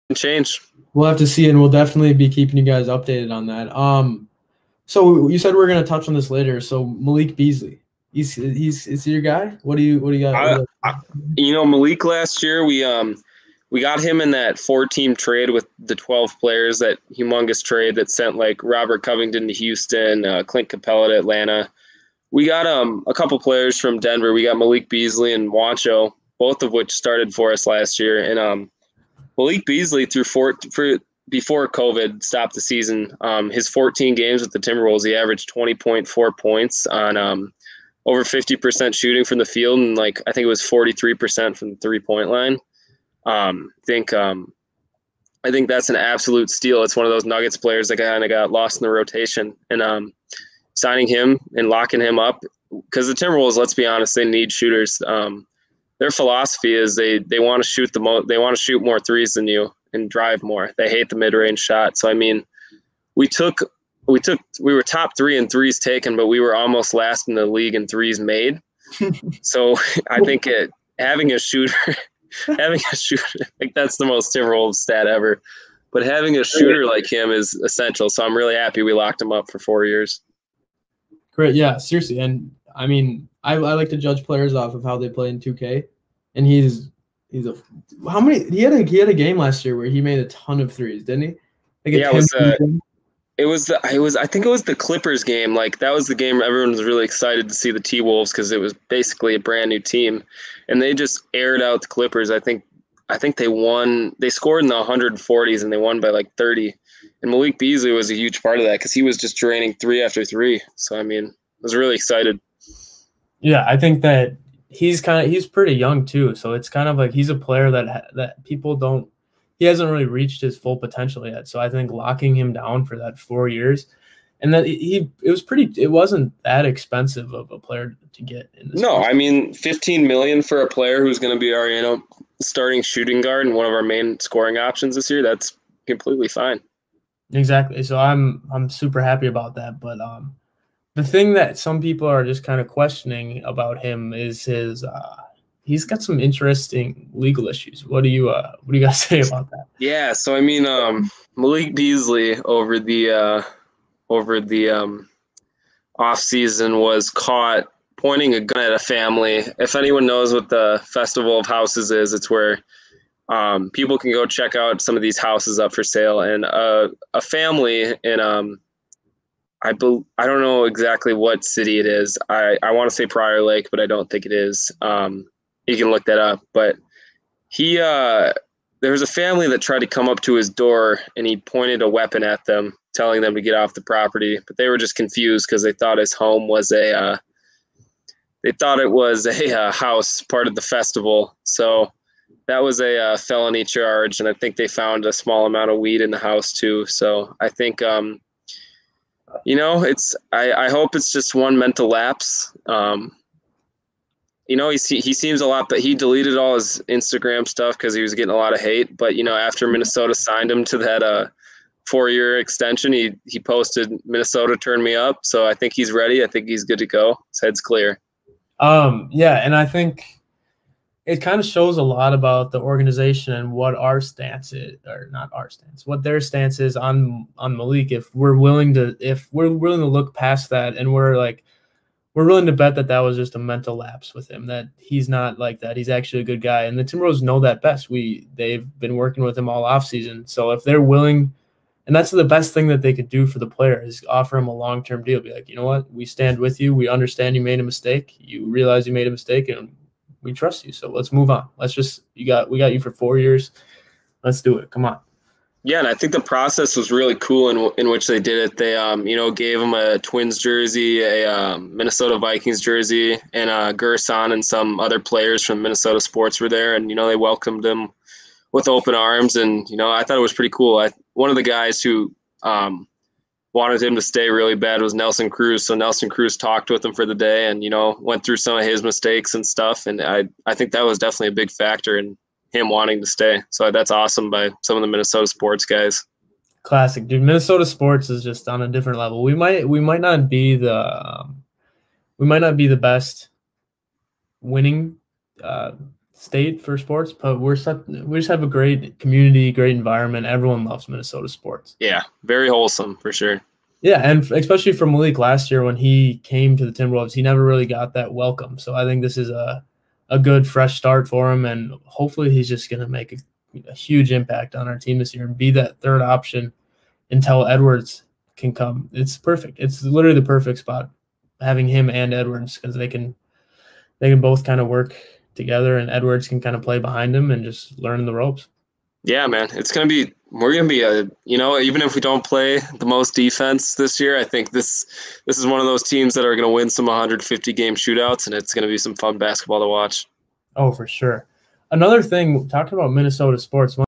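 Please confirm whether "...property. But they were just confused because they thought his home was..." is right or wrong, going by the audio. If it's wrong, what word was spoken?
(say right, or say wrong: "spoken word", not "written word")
right.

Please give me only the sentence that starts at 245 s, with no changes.
Be like, you know what, we stand with you.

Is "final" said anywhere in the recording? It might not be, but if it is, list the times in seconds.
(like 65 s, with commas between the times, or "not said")
not said.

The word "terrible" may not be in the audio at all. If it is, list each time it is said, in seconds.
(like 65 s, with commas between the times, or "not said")
74 s.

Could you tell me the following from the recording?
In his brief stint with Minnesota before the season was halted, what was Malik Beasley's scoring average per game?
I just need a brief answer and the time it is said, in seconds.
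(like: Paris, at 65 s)
20.4 points, at 35 s.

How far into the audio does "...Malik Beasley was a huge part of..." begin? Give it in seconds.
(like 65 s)
107 s.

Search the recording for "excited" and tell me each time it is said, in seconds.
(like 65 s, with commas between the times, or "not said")
97 s, 111 s.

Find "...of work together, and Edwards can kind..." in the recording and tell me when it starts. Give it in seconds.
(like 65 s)
324 s.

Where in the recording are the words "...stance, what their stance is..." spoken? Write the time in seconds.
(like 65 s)
225 s.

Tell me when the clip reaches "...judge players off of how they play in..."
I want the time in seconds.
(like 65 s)
83 s.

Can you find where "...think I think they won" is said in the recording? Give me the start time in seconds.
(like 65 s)
102 s.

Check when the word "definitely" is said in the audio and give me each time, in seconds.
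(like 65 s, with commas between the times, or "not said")
1 s, 280 s.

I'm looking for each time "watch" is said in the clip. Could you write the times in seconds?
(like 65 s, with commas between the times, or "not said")
339 s.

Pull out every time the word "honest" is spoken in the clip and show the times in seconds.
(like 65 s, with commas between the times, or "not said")
53 s.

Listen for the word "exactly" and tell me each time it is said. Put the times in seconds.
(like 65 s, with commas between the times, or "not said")
137 s, 170 s.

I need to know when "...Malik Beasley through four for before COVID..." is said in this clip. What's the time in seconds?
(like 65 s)
29 s.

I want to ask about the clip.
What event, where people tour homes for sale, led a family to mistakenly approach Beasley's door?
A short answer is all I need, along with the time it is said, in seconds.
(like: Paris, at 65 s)
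Festival of Houses, at 160 s.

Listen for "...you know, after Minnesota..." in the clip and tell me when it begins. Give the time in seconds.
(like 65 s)
209 s.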